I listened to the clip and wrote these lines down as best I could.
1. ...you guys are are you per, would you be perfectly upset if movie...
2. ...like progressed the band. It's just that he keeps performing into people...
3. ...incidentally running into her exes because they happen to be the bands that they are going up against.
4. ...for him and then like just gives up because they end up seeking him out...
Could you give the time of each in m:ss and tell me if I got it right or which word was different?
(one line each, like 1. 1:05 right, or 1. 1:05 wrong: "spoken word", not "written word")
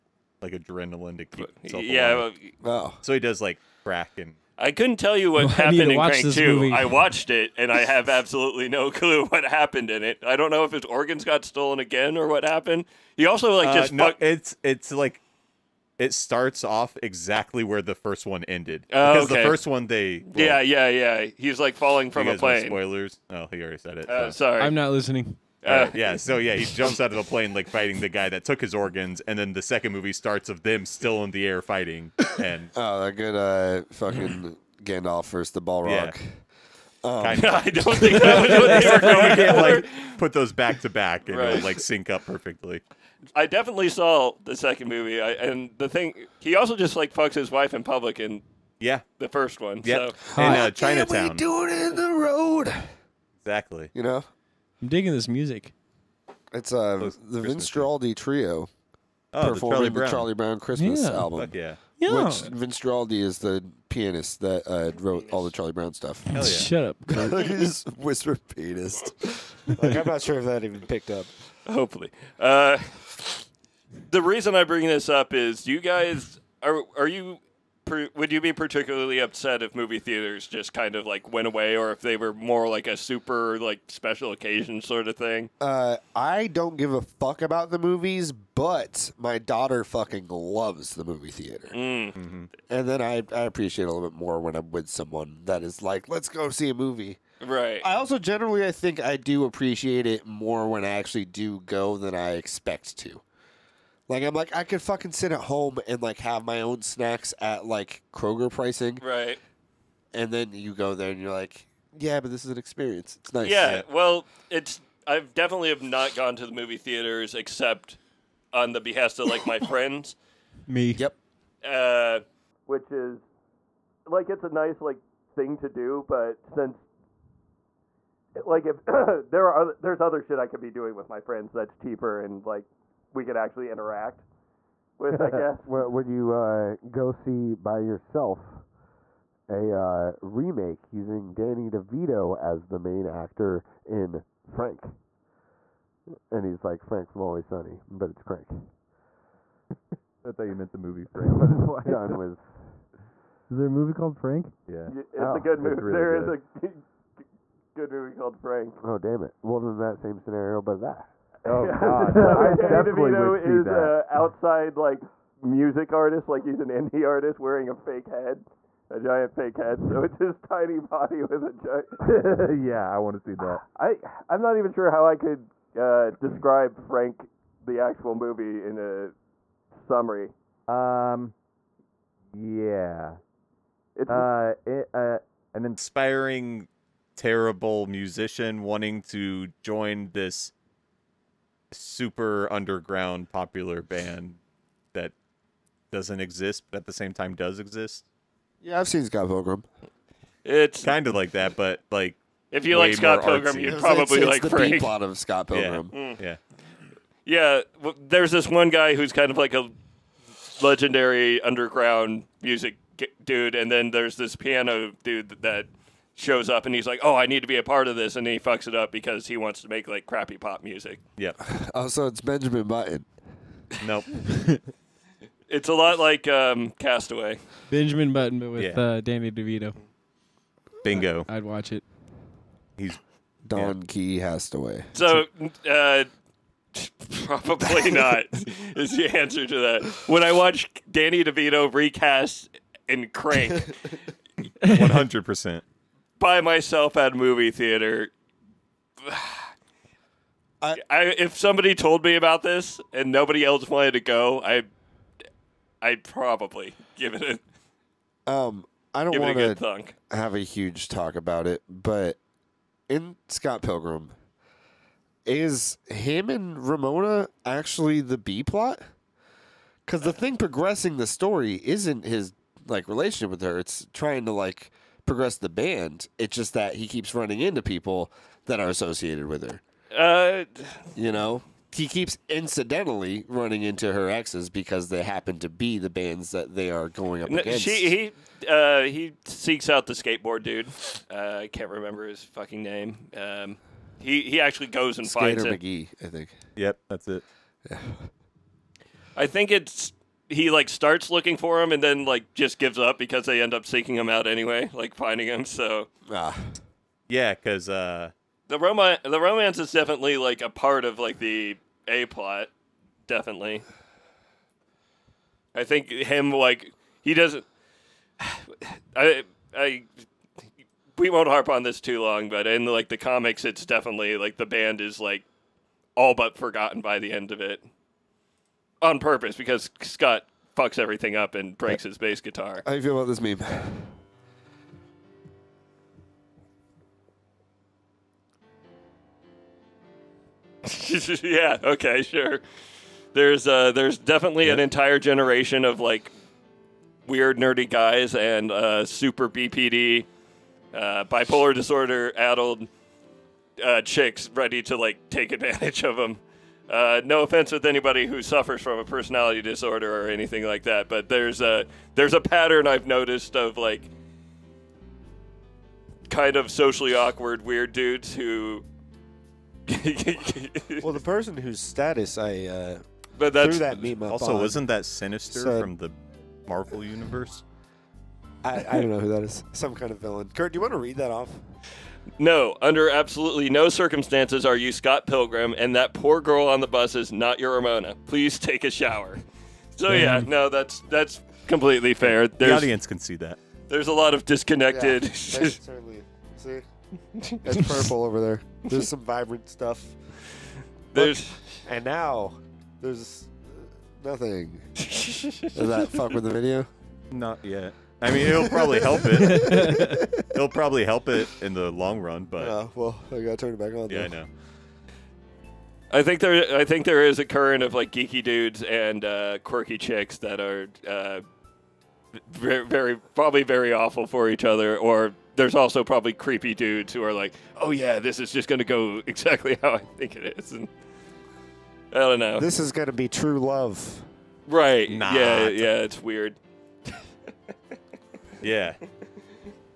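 1. 1:15 wrong: "particularly", not "perfectly"
2. 4:34 wrong: "running", not "performing"
3. 4:42 right
4. 5:01 right.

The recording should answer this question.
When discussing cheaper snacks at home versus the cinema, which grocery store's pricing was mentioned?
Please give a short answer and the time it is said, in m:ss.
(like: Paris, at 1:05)
Kroger, at 1:48.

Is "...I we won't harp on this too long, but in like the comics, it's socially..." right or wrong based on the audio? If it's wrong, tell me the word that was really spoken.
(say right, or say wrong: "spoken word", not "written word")
wrong: "definitely", not "socially".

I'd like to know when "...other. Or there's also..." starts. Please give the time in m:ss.
7:04.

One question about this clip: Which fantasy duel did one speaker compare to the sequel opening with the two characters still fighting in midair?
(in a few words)
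Gandalf versus the Balrog.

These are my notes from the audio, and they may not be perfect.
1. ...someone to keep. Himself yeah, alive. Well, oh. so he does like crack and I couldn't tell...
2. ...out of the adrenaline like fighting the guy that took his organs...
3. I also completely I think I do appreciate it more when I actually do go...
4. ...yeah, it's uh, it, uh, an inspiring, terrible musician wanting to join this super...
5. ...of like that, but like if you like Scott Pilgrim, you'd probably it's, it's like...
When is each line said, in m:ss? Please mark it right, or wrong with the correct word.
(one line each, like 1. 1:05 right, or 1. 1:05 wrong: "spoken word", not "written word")
1. 0:00 wrong: "adrenaline", not "someone"
2. 0:26 wrong: "plane", not "adrenaline"
3. 1:37 wrong: "generally", not "completely"
4. 3:02 right
5. 3:21 right.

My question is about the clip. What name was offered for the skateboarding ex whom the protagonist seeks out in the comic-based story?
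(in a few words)
McGee.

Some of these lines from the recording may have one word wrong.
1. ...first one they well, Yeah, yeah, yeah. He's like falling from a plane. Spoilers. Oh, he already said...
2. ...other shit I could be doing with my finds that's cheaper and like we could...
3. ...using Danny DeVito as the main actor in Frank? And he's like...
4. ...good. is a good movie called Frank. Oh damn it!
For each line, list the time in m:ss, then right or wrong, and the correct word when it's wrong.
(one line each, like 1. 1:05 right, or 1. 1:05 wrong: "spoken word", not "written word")
1. 0:19 right
2. 2:10 wrong: "friends", not "finds"
3. 2:20 right
4. 2:36 right.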